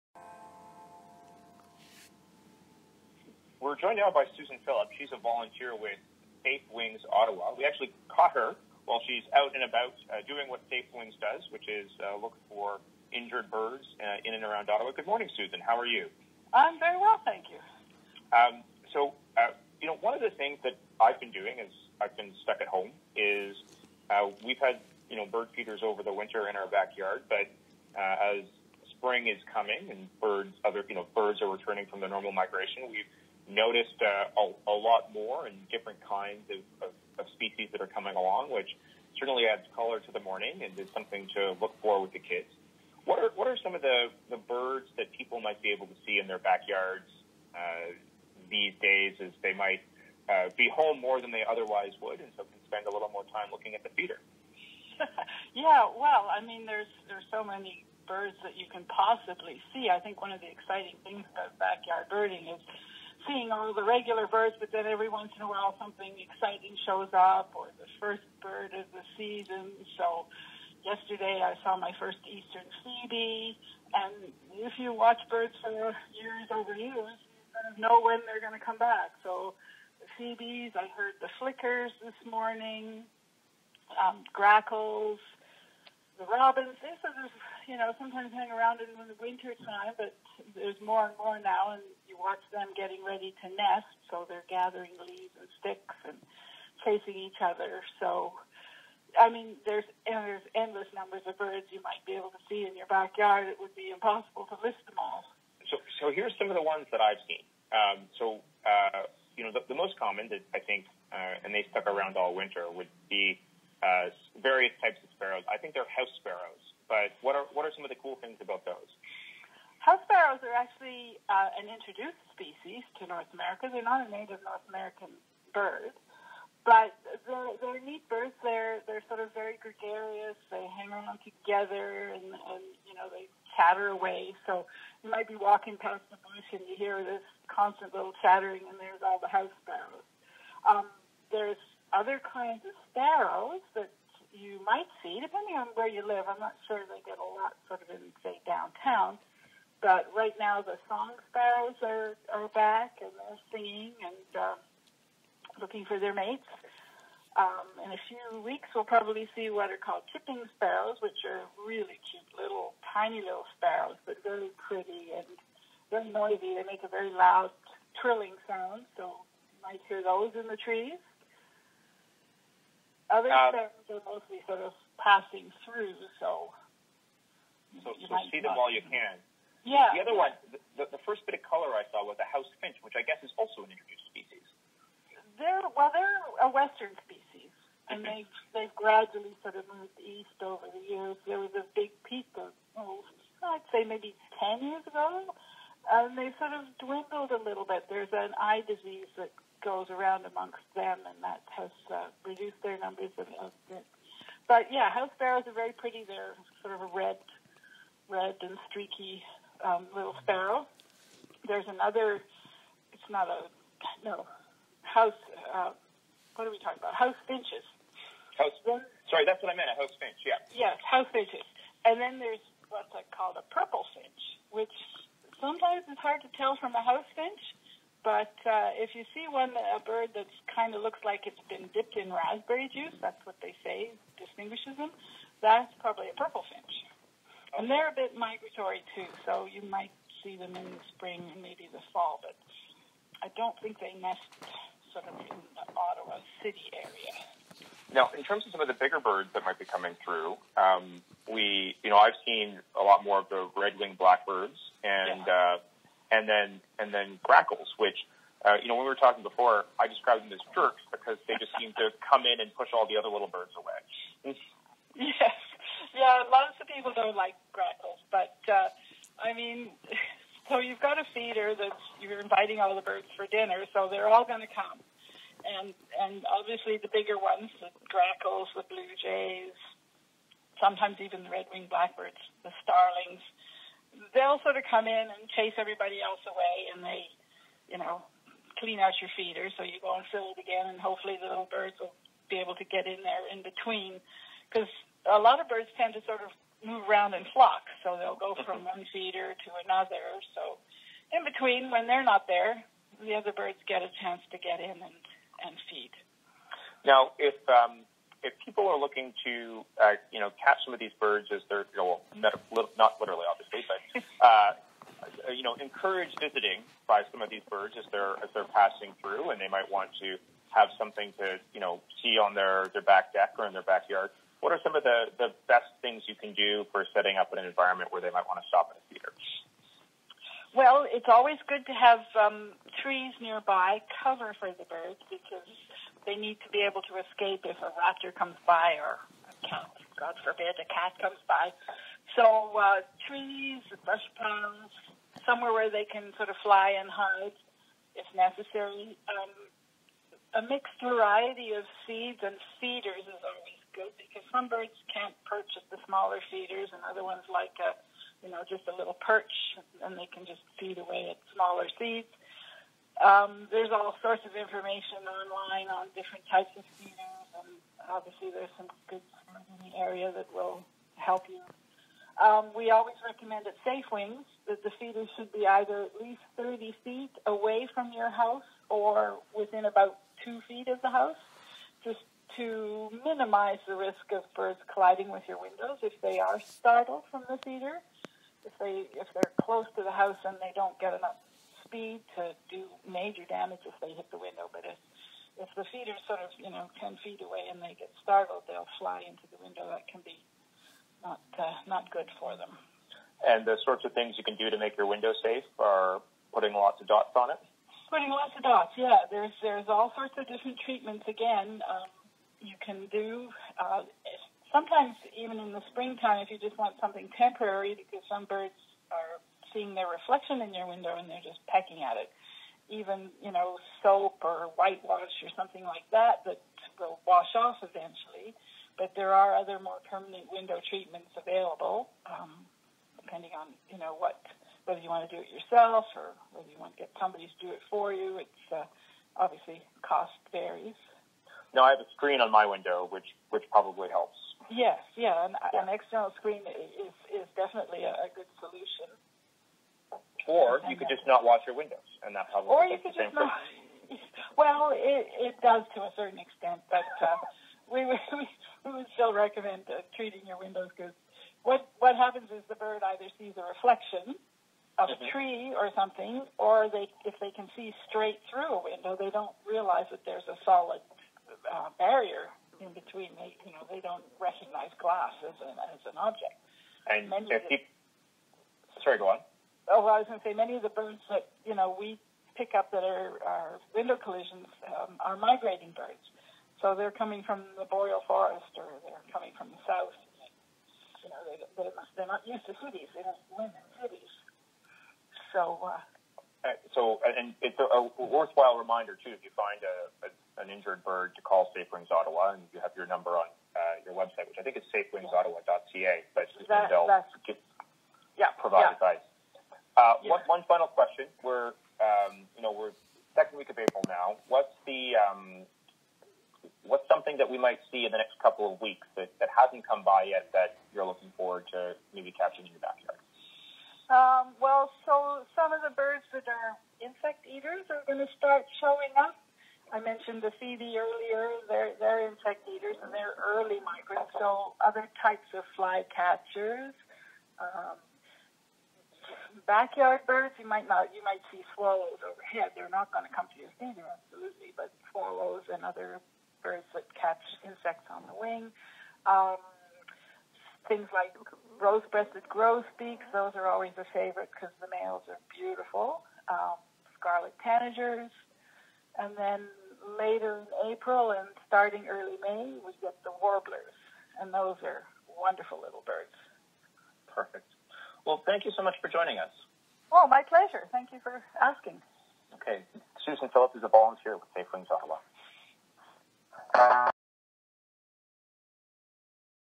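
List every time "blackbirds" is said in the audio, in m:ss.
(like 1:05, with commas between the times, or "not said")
4:13, 4:41.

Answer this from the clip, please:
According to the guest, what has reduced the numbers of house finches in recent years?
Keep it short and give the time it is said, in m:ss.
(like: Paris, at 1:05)
An eye disease, at 3:18.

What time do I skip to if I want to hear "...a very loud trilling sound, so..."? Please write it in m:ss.
2:46.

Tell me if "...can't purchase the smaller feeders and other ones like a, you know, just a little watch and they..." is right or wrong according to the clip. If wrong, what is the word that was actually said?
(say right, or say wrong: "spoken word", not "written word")
wrong: "perch", not "watch".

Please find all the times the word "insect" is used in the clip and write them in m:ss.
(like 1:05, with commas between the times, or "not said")
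8:46, 8:52, 9:07.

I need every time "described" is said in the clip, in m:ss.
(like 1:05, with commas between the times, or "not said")
4:19.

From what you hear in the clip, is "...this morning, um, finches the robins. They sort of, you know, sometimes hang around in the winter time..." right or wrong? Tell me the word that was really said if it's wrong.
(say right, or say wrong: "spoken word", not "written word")
wrong: "grackles", not "finches".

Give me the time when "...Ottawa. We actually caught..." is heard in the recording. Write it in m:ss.
0:07.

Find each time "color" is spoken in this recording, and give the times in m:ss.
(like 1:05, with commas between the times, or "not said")
0:39, 3:01.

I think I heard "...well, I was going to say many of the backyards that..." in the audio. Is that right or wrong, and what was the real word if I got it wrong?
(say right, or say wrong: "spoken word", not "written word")
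wrong: "birds", not "backyards".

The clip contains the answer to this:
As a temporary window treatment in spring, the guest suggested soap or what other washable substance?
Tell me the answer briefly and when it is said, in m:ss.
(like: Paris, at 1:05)
Whitewash, at 7:04.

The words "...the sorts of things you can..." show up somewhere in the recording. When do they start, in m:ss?
6:43.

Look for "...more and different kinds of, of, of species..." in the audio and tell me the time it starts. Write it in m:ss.
0:35.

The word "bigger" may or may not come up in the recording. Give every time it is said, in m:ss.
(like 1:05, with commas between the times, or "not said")
4:08, 4:36.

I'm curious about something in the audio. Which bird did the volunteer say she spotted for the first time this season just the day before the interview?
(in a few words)
Eastern phoebe.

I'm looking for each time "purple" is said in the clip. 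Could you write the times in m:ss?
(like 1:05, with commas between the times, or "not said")
3:43, 3:56.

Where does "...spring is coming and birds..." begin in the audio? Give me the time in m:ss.
0:28.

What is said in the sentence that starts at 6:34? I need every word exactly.
But if if the feet are sort of you know ten feet away and they get startled, they'll fly into the window.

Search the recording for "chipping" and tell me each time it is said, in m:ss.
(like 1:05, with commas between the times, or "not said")
2:40.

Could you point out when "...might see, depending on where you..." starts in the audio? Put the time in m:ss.
2:24.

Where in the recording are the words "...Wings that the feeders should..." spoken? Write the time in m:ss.
6:13.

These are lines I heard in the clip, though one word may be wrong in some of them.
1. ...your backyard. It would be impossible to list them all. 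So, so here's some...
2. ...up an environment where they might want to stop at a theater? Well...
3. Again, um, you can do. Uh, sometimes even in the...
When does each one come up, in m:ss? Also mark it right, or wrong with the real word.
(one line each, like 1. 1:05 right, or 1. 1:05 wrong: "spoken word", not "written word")
1. 1:42 right
2. 5:27 right
3. 6:51 right.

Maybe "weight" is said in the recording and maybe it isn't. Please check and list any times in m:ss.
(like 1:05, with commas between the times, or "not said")
not said.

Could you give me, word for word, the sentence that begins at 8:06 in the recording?
So they're coming from the boreal forest, or they're coming from the south.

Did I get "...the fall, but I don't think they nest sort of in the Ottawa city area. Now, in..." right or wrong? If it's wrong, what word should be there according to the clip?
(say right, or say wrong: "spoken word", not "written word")
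right.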